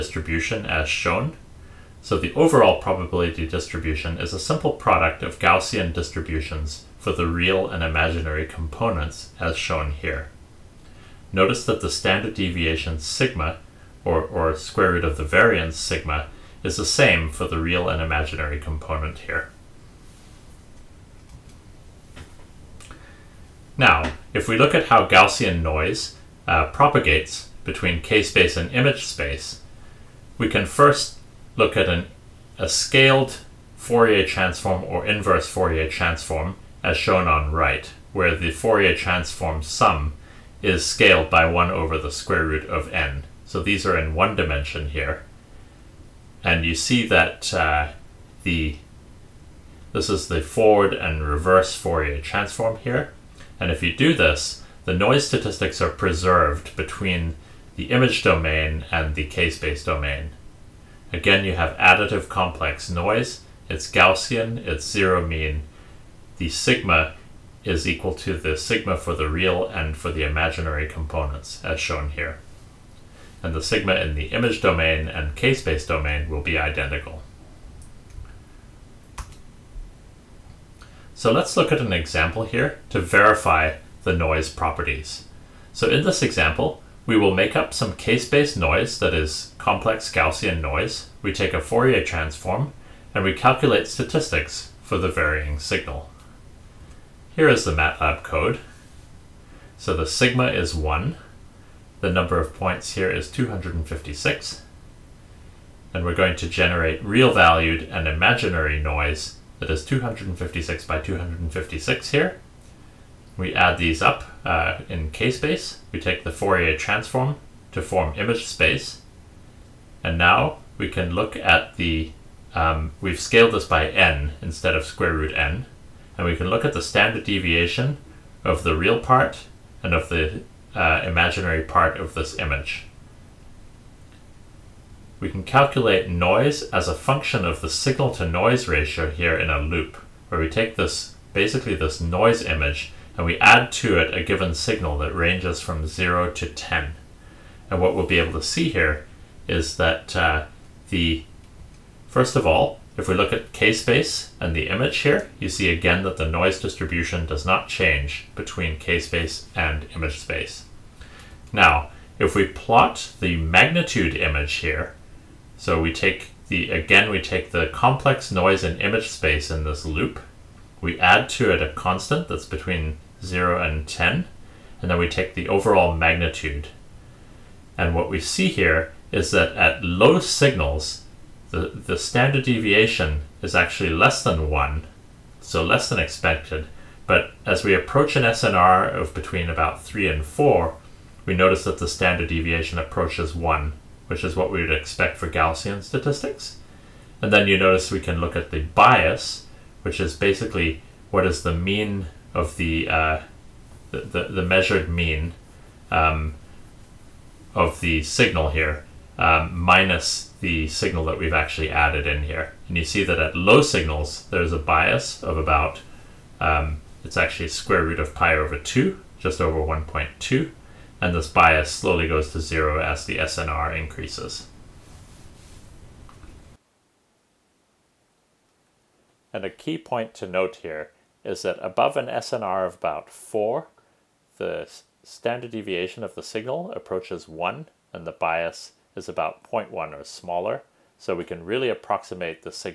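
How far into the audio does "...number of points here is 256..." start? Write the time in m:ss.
1:42.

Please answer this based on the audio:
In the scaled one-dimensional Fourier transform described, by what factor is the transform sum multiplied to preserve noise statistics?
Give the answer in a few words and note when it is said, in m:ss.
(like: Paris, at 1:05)
1 over the square root of n, at 0:41.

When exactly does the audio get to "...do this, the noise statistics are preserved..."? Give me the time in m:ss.
0:53.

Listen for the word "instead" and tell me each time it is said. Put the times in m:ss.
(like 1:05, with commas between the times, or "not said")
2:04.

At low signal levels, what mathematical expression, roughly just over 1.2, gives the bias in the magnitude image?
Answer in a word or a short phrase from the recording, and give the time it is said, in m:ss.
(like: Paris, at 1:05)
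square root of pi over 2, at 3:37.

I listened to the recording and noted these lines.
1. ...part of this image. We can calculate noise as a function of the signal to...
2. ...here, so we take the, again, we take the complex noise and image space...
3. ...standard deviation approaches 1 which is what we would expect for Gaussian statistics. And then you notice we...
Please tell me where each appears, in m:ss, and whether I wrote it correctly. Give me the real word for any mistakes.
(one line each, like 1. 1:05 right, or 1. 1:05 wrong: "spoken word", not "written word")
1. 2:11 right
2. 2:44 right
3. 3:11 right.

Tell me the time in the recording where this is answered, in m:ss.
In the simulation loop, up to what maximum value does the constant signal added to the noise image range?
2:25.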